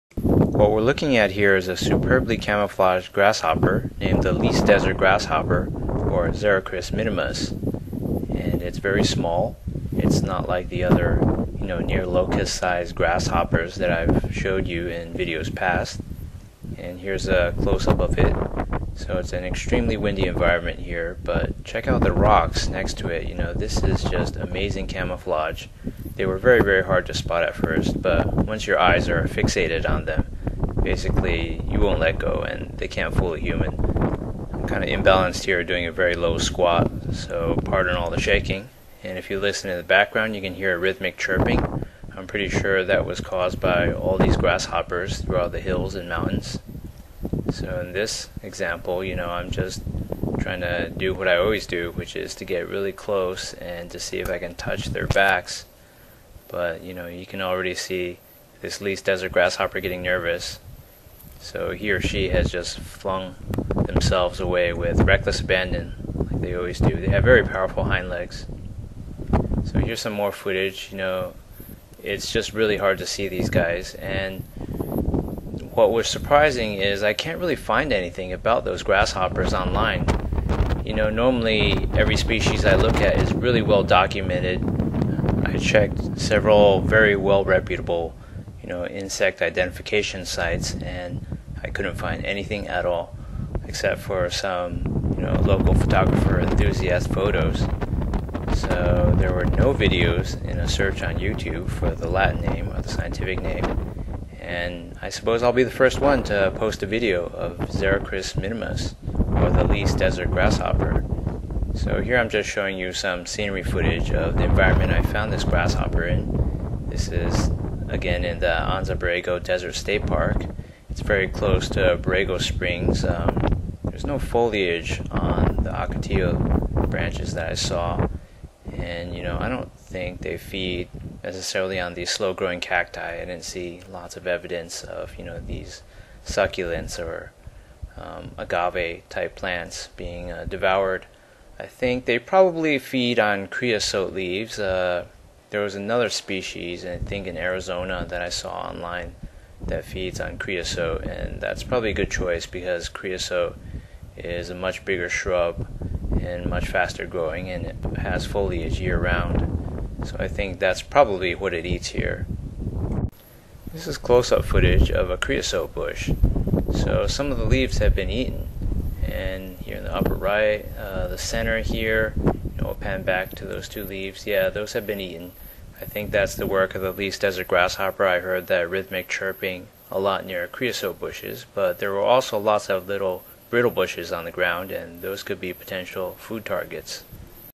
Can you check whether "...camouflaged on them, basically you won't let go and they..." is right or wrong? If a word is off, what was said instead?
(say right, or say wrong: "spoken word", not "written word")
wrong: "fixated", not "camouflaged".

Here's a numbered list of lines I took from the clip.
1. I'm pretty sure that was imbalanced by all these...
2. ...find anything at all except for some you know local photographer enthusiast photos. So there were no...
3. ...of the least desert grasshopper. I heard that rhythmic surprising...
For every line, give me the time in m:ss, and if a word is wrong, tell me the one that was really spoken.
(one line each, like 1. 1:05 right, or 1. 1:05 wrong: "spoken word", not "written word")
1. 0:42 wrong: "caused", not "imbalanced"
2. 1:31 right
3. 2:56 wrong: "chirping", not "surprising".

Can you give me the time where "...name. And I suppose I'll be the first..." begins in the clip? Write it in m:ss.
1:43.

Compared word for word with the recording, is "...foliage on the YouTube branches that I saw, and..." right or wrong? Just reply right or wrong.
wrong.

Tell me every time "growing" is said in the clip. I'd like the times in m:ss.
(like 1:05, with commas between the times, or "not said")
2:12, 2:37.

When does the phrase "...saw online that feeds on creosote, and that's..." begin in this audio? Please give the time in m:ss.
2:28.